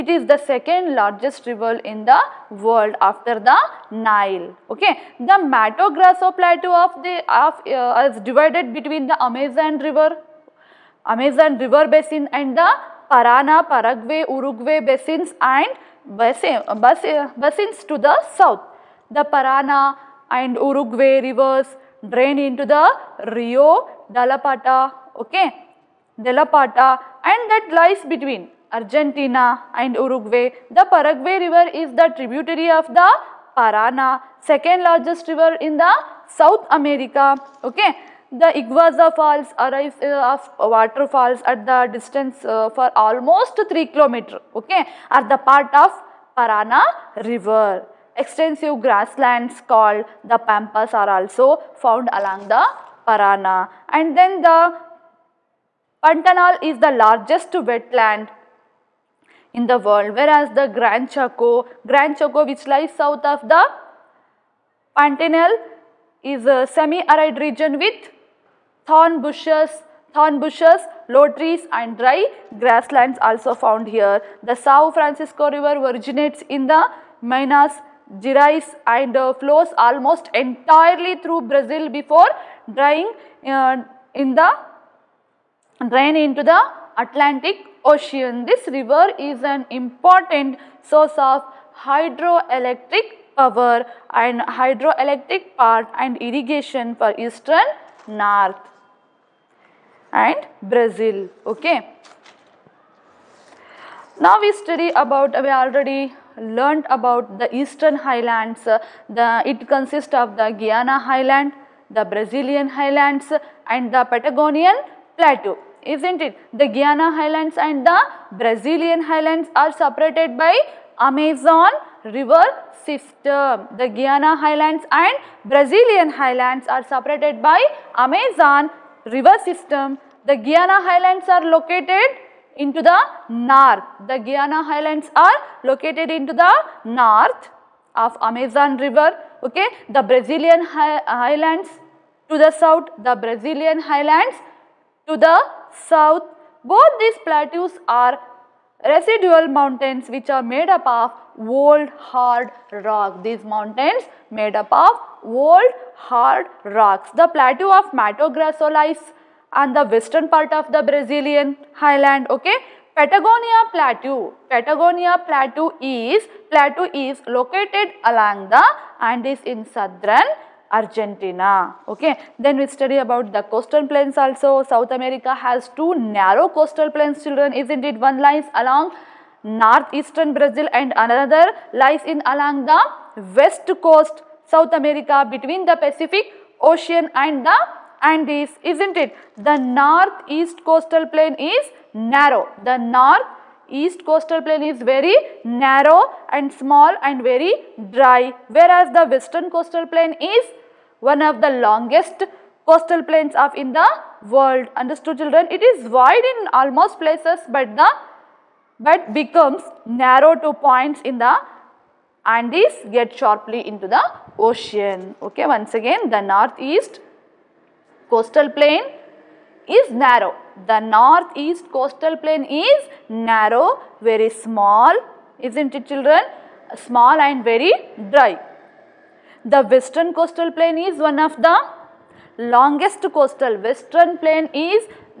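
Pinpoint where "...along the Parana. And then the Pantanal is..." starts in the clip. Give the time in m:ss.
0:52.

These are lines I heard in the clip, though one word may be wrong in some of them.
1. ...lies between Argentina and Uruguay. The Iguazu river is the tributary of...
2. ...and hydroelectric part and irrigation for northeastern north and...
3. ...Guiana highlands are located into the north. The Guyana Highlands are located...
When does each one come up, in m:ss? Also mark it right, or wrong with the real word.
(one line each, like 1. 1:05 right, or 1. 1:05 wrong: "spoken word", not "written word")
1. 0:27 wrong: "Paraguay", not "Iguazu"
2. 1:34 wrong: "eastern", not "northeastern"
3. 2:10 right.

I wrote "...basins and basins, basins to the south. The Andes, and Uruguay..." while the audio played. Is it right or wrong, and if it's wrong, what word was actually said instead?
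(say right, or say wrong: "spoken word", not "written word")
wrong: "Parana", not "Andes".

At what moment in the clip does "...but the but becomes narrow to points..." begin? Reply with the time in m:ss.
3:27.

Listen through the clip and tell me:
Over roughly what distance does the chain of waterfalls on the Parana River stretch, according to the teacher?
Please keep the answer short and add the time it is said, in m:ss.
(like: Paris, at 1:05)
almost 3 km, at 0:42.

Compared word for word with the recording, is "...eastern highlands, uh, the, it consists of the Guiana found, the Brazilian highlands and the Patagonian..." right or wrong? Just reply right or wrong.
wrong.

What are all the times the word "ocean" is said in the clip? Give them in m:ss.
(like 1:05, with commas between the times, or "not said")
1:27, 3:06, 3:34.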